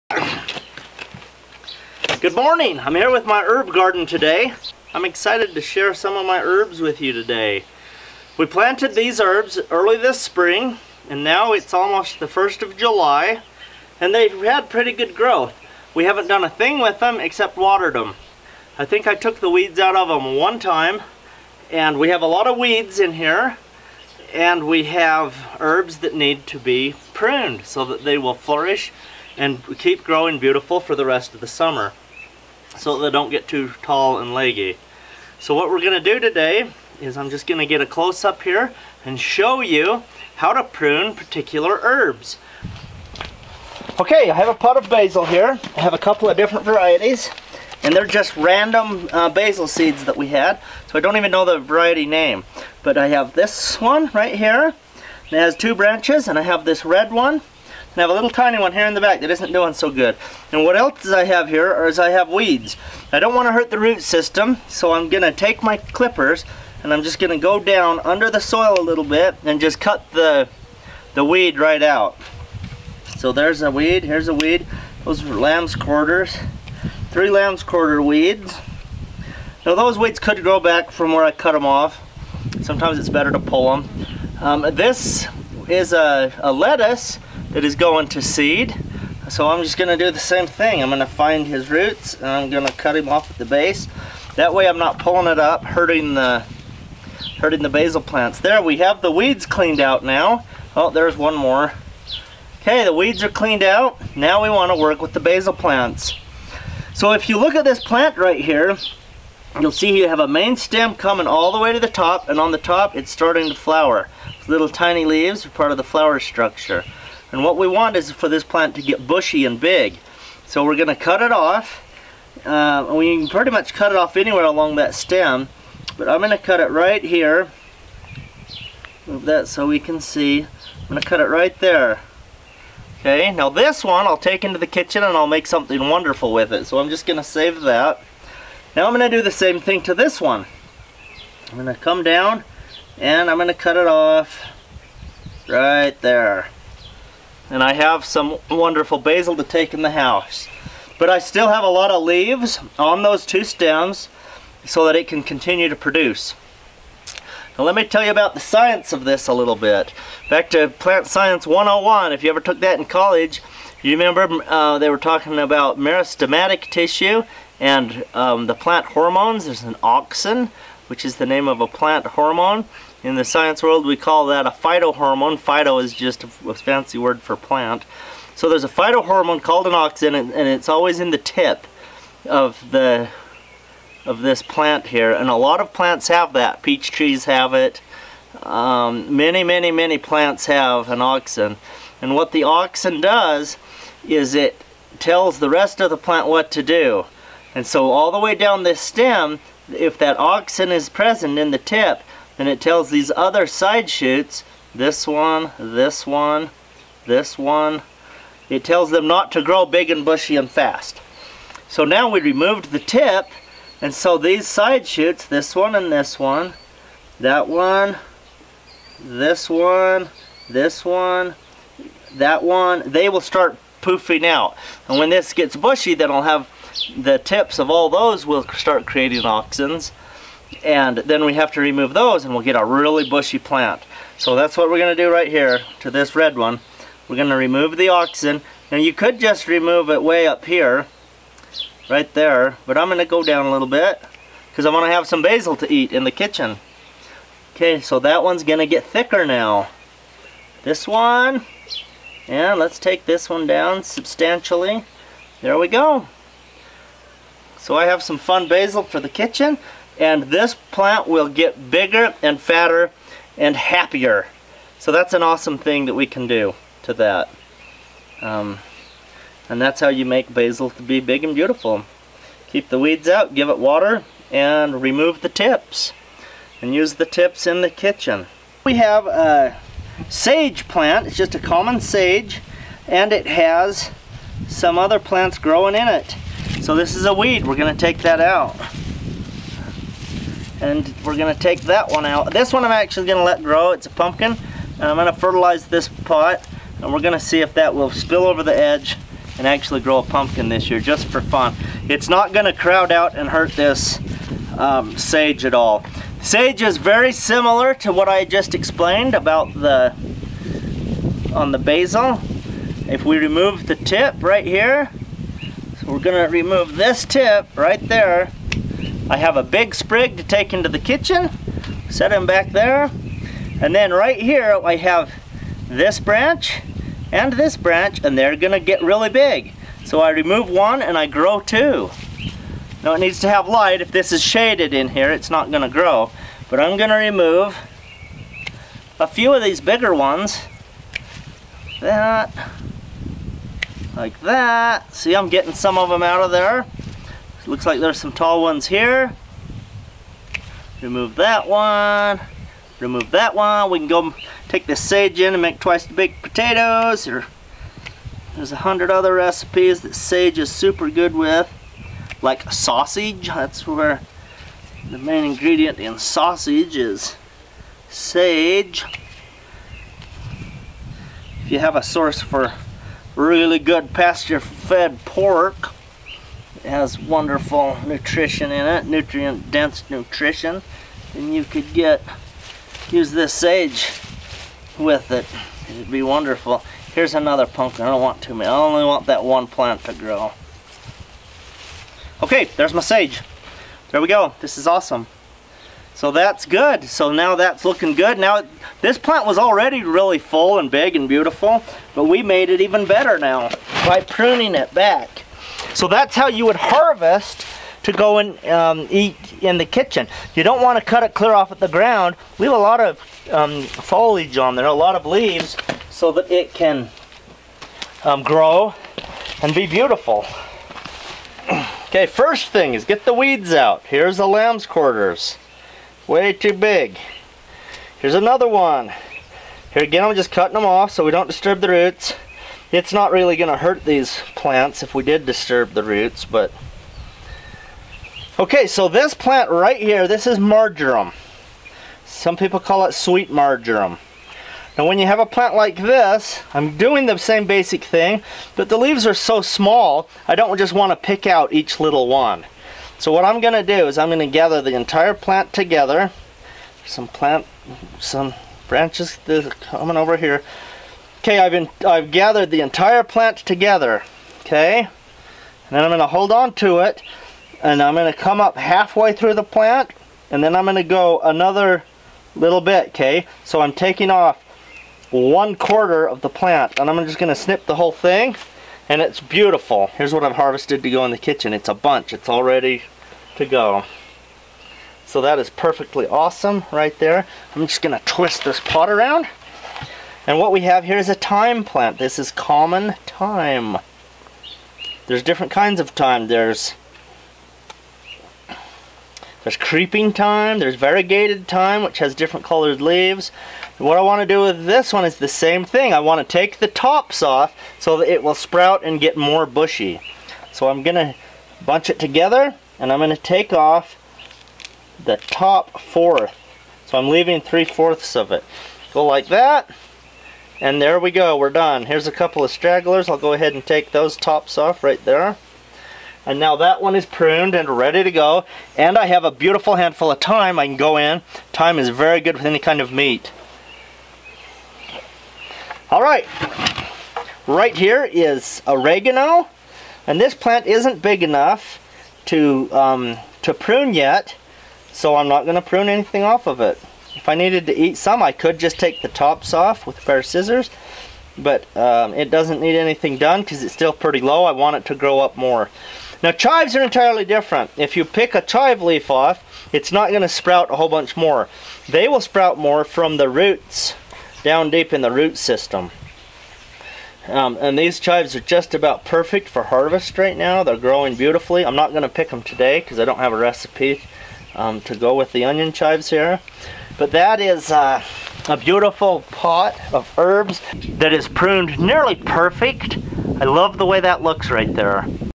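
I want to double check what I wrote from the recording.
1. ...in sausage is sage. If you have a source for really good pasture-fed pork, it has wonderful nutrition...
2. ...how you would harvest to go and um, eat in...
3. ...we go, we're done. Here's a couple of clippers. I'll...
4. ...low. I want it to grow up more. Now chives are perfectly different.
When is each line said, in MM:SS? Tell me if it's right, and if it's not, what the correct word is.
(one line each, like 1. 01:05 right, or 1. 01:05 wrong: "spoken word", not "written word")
1. 06:05 right
2. 06:46 right
3. 08:40 wrong: "stragglers", not "clippers"
4. 09:14 wrong: "entirely", not "perfectly".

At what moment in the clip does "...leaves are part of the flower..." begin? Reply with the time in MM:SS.
01:55.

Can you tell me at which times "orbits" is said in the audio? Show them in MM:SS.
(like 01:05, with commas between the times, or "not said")
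not said.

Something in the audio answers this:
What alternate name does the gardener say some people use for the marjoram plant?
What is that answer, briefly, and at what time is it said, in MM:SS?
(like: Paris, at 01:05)
sweet marjoram, at 07:22.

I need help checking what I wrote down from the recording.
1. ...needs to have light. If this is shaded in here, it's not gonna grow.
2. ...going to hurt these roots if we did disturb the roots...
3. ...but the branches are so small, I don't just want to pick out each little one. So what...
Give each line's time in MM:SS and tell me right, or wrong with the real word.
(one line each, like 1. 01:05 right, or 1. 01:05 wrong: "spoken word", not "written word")
1. 05:32 right
2. 07:13 wrong: "plants", not "roots"
3. 07:28 wrong: "leaves", not "branches".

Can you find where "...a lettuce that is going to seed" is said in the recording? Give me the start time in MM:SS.
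01:26.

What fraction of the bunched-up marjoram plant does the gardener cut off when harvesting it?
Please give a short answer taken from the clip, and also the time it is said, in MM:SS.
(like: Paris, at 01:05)
one quarter, at 07:55.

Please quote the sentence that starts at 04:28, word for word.
Um, and that's how you make basil to be big and beautiful.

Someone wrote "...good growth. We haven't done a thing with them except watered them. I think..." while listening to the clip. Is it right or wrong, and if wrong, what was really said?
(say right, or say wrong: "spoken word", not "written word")
right.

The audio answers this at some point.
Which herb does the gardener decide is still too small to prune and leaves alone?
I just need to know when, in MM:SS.
08:58.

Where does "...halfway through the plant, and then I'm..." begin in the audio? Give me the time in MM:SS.
07:48.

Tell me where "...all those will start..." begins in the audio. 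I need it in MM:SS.
03:47.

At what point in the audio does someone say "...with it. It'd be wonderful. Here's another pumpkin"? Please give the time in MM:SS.
06:24.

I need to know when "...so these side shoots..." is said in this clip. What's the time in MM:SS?
03:33.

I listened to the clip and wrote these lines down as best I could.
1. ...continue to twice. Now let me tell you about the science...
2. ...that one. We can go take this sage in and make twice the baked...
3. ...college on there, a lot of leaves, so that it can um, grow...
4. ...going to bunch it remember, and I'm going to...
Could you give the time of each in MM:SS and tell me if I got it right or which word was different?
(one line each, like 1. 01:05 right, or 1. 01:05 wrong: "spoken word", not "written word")
1. 02:35 wrong: "produce", not "twice"
2. 05:53 right
3. 06:53 wrong: "foliage", not "college"
4. 08:30 wrong: "together", not "remember".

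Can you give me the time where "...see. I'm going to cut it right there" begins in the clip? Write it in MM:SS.
02:10.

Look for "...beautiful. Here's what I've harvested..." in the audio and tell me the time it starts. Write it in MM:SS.
07:59.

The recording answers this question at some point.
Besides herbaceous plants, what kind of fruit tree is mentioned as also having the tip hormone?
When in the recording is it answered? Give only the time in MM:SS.
03:06.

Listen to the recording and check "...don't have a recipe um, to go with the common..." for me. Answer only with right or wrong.
wrong.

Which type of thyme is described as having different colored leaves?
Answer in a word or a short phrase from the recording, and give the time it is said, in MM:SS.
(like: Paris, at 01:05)
variegated thyme, at 08:20.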